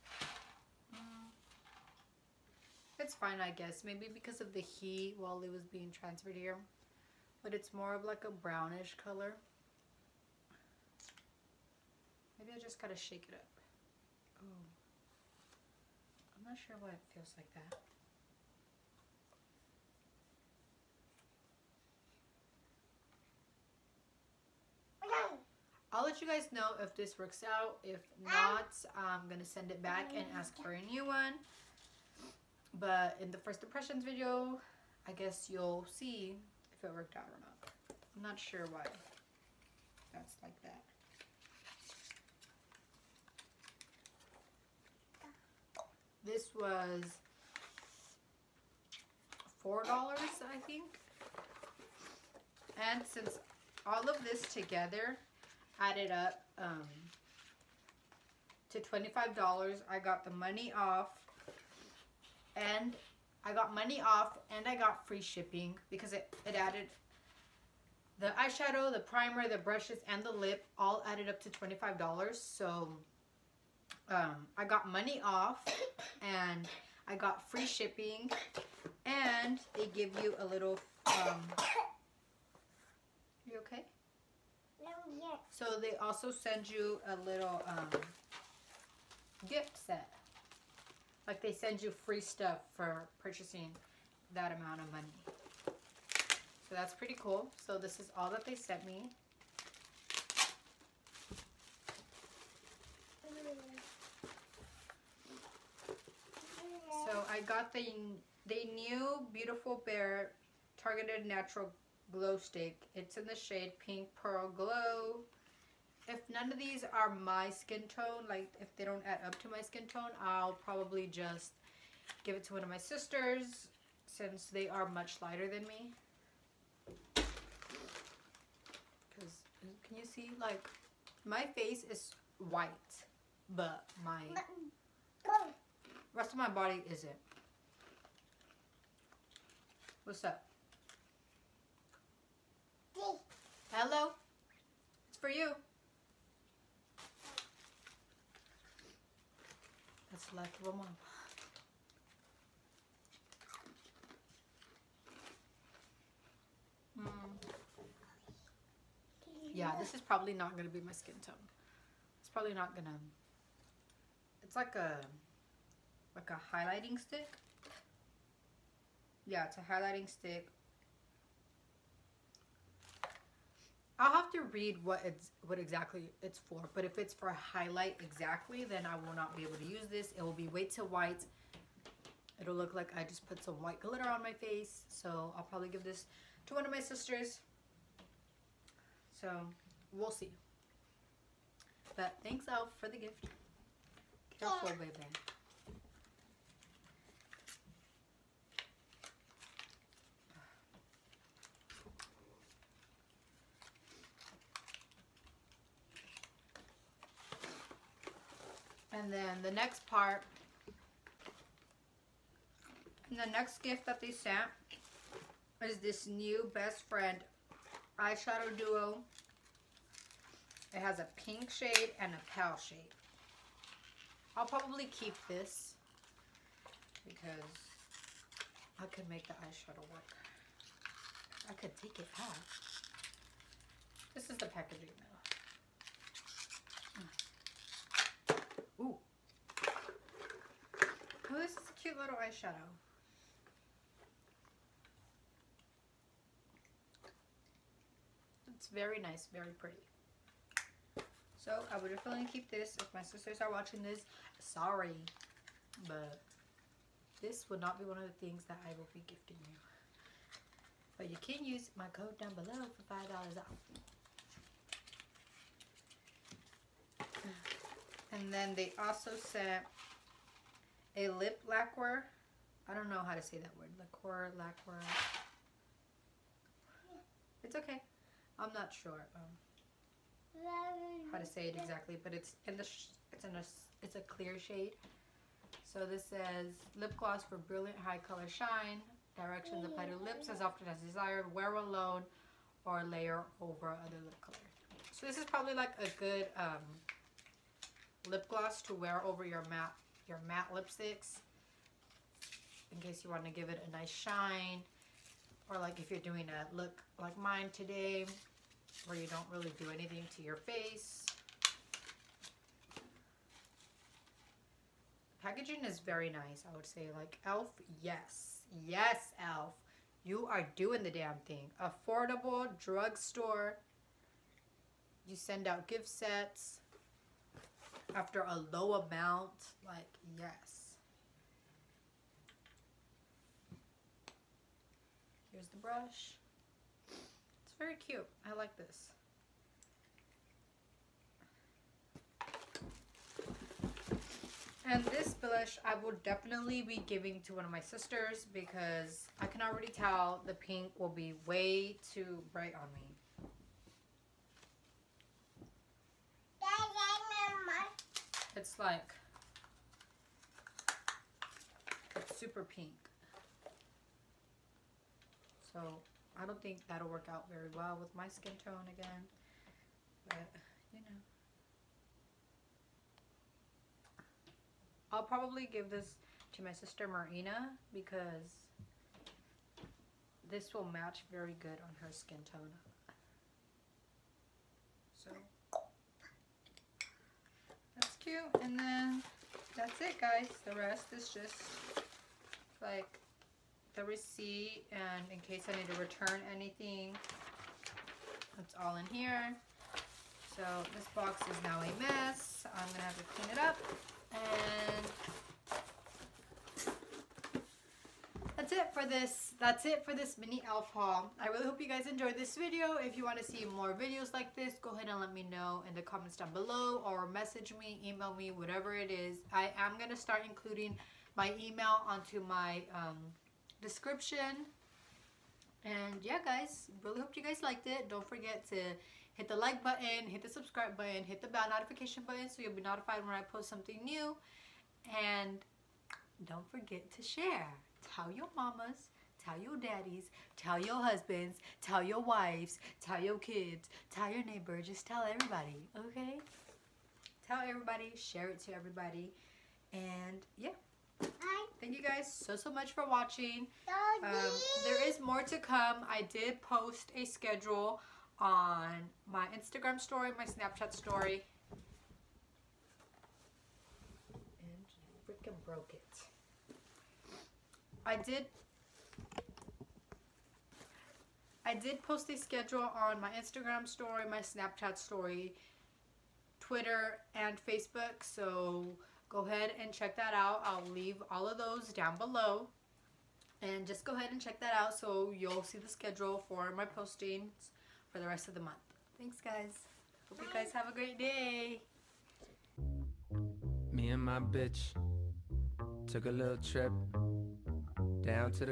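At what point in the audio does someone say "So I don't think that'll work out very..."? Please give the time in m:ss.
6:05.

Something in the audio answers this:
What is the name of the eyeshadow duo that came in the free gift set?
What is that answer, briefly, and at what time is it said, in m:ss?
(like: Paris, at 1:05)
Best Friend, at 3:36.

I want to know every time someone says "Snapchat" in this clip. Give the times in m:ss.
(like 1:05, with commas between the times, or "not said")
7:40, 7:54.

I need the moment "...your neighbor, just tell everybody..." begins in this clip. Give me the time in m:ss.
7:24.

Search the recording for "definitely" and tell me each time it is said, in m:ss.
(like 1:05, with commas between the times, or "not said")
4:11, 5:46.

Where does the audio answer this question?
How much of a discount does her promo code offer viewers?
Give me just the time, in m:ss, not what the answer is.
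4:22.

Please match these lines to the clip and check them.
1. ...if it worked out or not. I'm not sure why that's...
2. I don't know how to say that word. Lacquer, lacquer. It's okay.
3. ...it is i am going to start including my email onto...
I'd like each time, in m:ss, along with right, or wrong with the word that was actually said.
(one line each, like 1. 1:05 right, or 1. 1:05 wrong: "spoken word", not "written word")
1. 0:36 right
2. 4:32 right
3. 6:58 right.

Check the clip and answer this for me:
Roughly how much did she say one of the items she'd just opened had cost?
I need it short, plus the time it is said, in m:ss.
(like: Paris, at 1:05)
$4, at 0:49.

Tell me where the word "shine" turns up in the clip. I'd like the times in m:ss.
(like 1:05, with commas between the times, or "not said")
4:48, 5:03.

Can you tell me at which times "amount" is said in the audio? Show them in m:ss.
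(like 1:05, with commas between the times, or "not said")
1:34, 5:28.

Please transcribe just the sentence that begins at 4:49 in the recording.
Directions apply to lips as often as desired.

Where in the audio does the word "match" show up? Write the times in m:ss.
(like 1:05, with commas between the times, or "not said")
6:20.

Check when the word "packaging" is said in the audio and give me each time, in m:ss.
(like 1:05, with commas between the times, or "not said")
3:54, 5:15.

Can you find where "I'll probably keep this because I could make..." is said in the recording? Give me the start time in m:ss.
3:44.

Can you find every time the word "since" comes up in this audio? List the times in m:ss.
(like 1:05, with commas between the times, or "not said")
0:53, 2:04.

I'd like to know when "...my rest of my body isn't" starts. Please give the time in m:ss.
2:14.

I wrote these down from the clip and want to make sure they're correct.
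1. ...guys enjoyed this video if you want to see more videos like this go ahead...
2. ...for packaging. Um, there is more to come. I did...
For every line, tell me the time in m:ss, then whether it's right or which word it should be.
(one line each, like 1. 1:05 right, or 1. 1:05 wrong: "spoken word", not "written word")
1. 6:51 right
2. 7:32 wrong: "watching", not "packaging".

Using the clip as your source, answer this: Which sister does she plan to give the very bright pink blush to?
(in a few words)
Marina.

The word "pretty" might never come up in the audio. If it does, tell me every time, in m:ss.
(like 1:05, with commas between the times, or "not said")
1:36, 4:09.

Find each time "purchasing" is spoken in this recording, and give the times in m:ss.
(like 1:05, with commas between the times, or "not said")
1:33.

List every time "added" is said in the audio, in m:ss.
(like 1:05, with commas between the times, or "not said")
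0:55, 1:06, 1:11.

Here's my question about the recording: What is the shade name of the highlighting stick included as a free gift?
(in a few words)
Pink Pearl Glow.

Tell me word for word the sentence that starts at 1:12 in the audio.
So um, I got money off and I got free shipping and they give you a little, um, you okay?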